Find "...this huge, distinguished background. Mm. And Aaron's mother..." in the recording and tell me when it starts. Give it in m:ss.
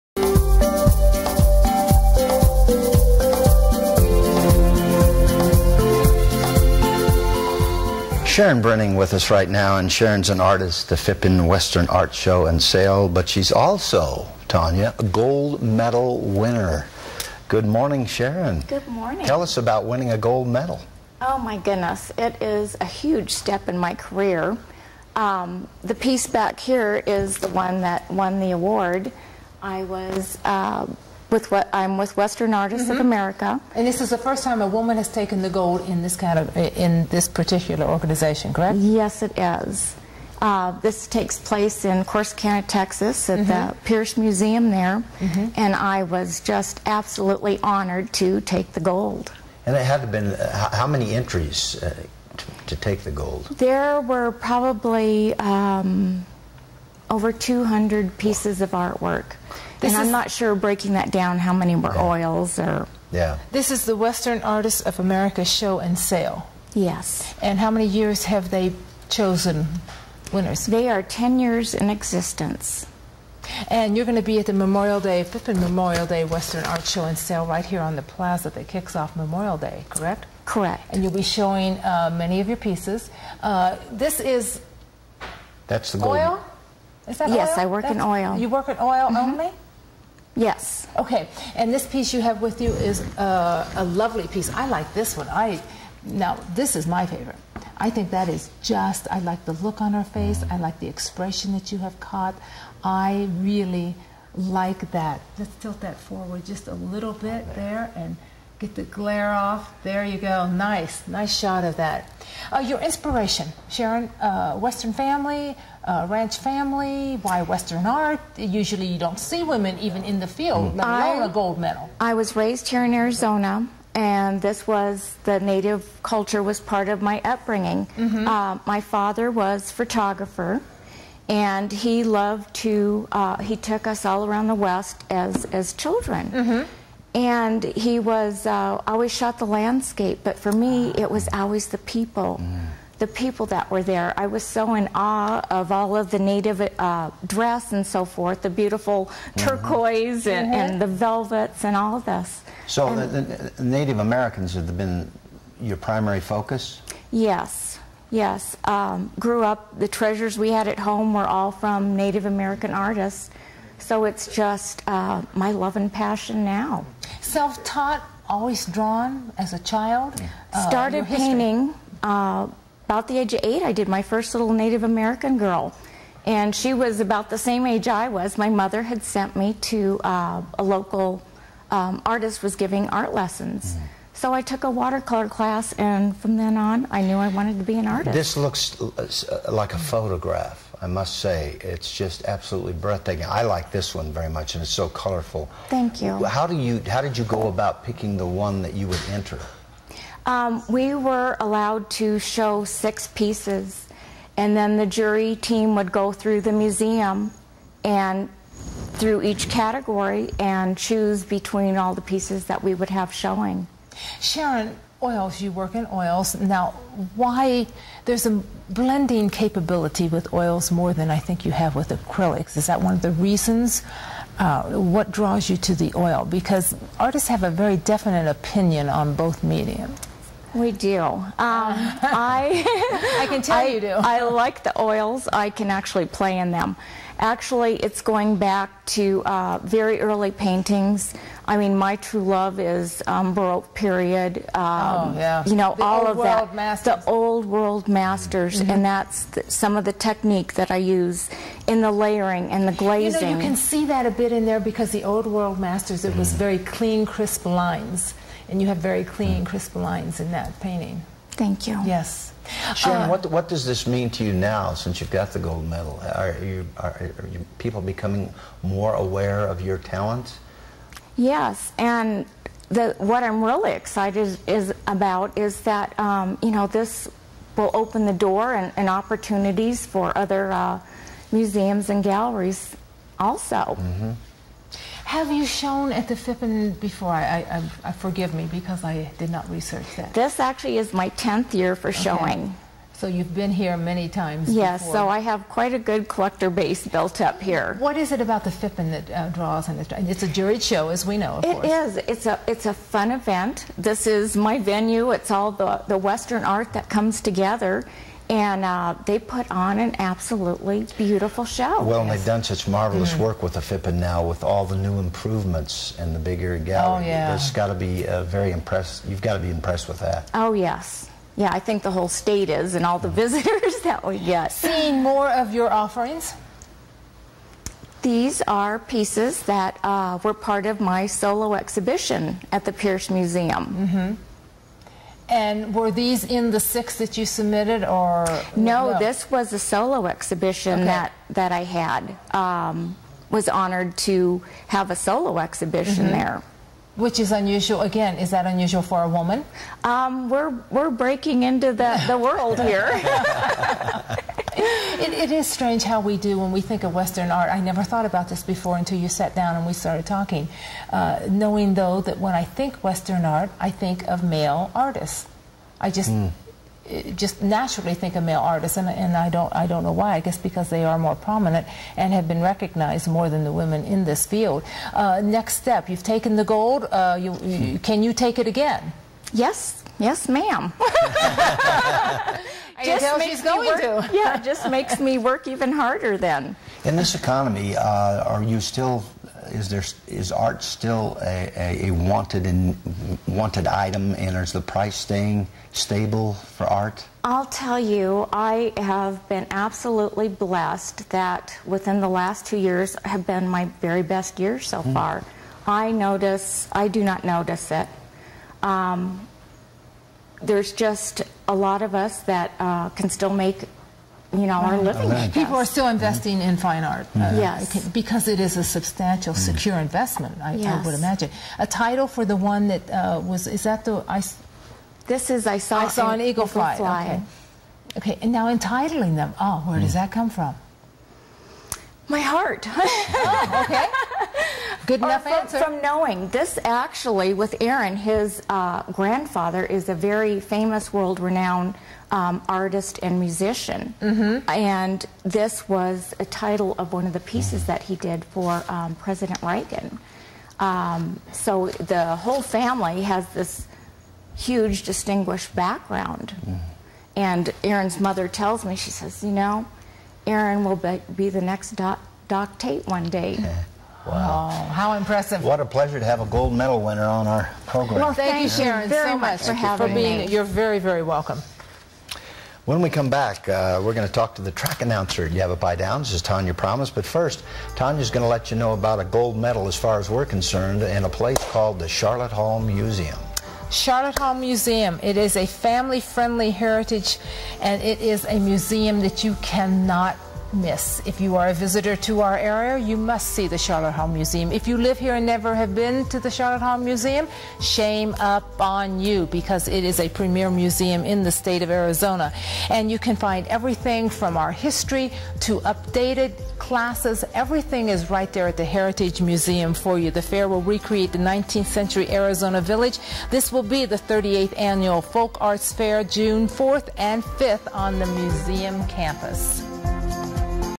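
7:33.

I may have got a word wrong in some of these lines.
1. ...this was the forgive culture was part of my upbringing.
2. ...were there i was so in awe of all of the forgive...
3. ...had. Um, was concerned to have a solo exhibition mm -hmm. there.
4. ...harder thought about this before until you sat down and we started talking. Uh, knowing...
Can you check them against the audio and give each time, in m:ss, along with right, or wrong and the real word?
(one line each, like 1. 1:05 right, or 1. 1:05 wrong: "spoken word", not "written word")
1. 2:04 wrong: "native", not "forgive"
2. 2:23 wrong: "native", not "forgive"
3. 5:41 wrong: "honored", not "concerned"
4. 5:57 wrong: "never", not "harder".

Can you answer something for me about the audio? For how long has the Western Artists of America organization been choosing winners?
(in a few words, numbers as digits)
10 years.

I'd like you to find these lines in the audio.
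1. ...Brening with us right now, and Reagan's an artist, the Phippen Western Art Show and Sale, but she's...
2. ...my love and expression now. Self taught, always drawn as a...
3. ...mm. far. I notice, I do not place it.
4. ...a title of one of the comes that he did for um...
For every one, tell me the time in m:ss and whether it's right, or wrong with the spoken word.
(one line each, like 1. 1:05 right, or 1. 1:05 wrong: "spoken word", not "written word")
1. 0:08 wrong: "Sharon", not "Reagan"
2. 2:45 wrong: "passion", not "expression"
3. 6:44 wrong: "notice", not "place"
4. 7:26 wrong: "pieces", not "comes".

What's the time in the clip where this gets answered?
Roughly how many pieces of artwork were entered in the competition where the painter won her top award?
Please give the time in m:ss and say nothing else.
0:57.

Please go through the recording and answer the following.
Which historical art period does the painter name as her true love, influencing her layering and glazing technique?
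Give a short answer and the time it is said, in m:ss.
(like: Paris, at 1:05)
Baroque, at 4:03.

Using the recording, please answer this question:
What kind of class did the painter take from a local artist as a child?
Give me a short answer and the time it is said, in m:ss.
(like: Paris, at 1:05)
watercolor class, at 3:04.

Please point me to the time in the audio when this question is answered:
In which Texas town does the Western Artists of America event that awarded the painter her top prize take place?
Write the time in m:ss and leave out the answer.
0:42.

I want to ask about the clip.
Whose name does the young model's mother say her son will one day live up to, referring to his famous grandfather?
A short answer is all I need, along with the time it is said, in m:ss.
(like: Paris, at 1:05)
Doc Tate, at 7:42.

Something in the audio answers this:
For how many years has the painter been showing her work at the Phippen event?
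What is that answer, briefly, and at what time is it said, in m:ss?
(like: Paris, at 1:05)
10th year, at 4:51.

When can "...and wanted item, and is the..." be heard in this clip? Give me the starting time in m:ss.
6:32.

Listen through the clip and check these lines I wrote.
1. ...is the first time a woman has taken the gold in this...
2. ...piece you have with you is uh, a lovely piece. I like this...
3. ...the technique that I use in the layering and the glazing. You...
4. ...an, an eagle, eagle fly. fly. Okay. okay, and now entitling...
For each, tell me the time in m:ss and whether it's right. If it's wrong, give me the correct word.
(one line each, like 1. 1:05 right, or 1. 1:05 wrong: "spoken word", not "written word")
1. 0:34 right
2. 1:31 right
3. 4:09 right
4. 7:06 right.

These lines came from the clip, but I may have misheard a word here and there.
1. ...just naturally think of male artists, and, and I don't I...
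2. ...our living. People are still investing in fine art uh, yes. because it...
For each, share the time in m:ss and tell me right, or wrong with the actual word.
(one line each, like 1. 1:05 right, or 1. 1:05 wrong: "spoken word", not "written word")
1. 6:07 right
2. 6:54 right.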